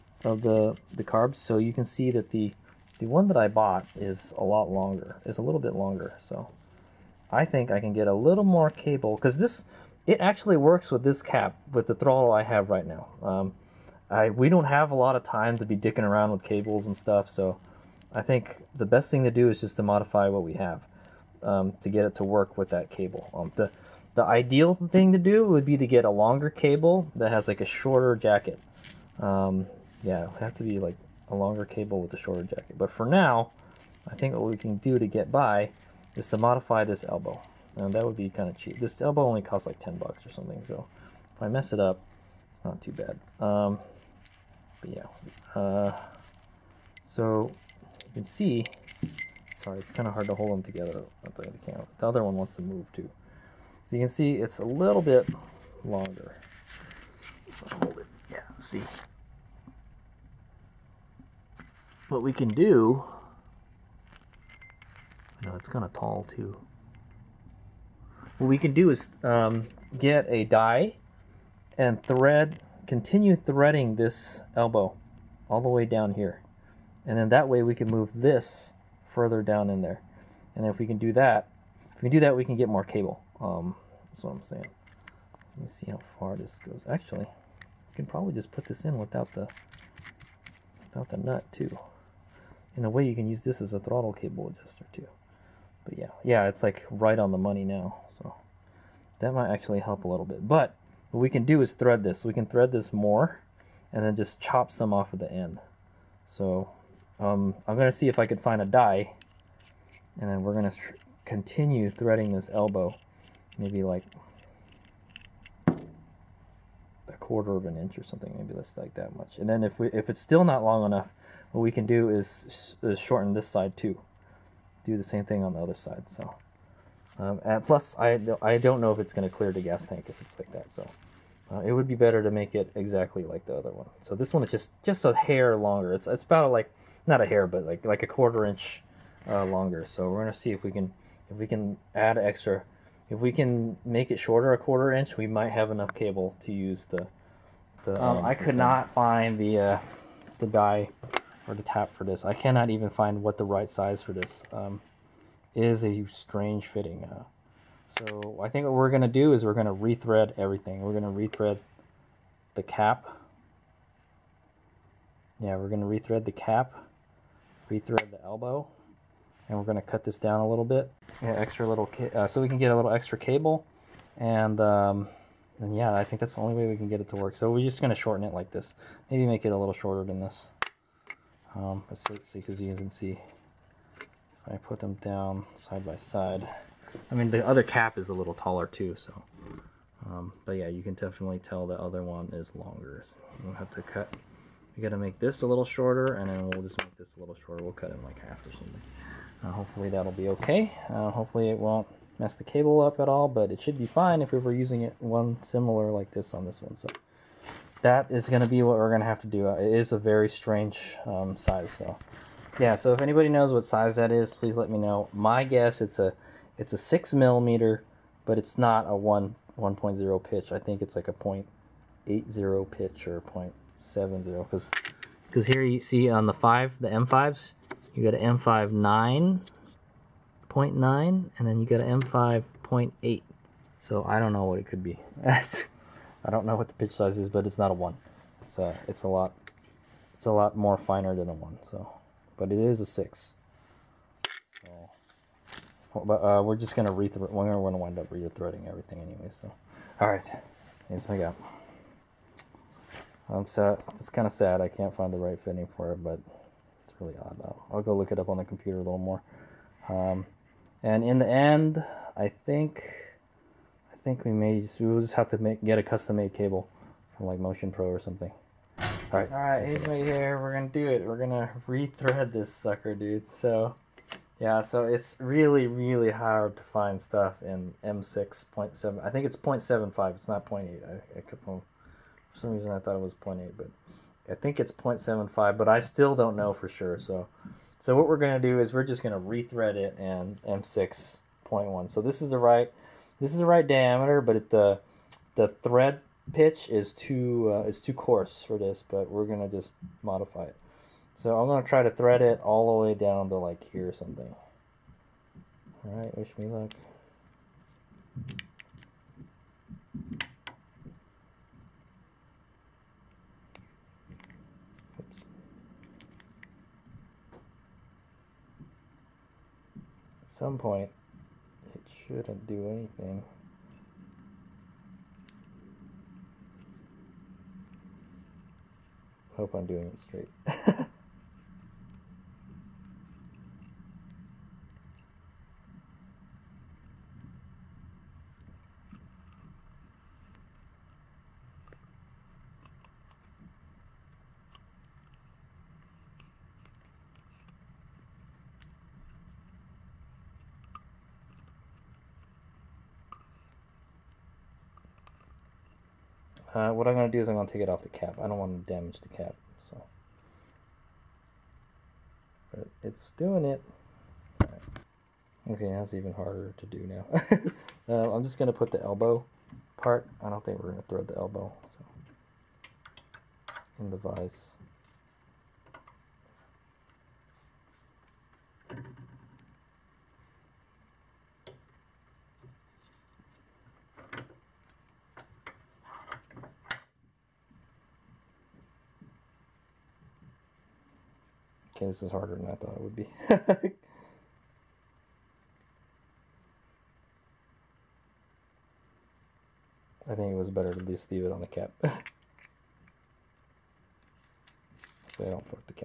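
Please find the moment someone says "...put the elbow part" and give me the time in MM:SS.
06:08.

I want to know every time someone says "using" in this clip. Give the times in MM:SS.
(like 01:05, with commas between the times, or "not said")
03:24.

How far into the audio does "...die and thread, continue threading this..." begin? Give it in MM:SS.
01:10.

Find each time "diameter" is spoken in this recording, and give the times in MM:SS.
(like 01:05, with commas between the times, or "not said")
04:53.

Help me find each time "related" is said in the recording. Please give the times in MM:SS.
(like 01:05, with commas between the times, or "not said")
not said.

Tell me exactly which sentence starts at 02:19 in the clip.
So we're gonna see if we can if we can add extra.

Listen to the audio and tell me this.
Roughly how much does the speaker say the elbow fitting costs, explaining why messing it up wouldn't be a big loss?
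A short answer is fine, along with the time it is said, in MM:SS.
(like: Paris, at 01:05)
10 bucks, at 00:39.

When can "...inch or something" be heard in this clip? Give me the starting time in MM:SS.
01:57.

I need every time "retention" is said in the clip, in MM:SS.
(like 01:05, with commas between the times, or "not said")
not said.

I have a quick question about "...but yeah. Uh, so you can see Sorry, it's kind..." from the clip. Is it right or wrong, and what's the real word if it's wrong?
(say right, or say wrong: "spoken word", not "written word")
right.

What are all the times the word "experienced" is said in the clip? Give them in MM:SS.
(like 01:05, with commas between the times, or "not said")
not said.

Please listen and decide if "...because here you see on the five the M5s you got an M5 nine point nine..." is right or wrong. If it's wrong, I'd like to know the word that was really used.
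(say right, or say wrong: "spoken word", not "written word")
right.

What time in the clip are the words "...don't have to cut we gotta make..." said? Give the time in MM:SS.
03:13.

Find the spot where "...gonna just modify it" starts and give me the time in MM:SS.
04:59.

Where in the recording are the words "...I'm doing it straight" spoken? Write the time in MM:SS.
05:29.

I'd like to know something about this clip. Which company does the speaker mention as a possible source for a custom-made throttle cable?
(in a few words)
Motion Pro.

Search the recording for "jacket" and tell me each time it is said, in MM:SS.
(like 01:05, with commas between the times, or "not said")
00:28, 00:32.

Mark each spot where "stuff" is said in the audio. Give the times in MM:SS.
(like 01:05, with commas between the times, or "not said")
00:16, 04:36.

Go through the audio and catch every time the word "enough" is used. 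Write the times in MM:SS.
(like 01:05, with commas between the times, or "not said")
02:00, 02:25.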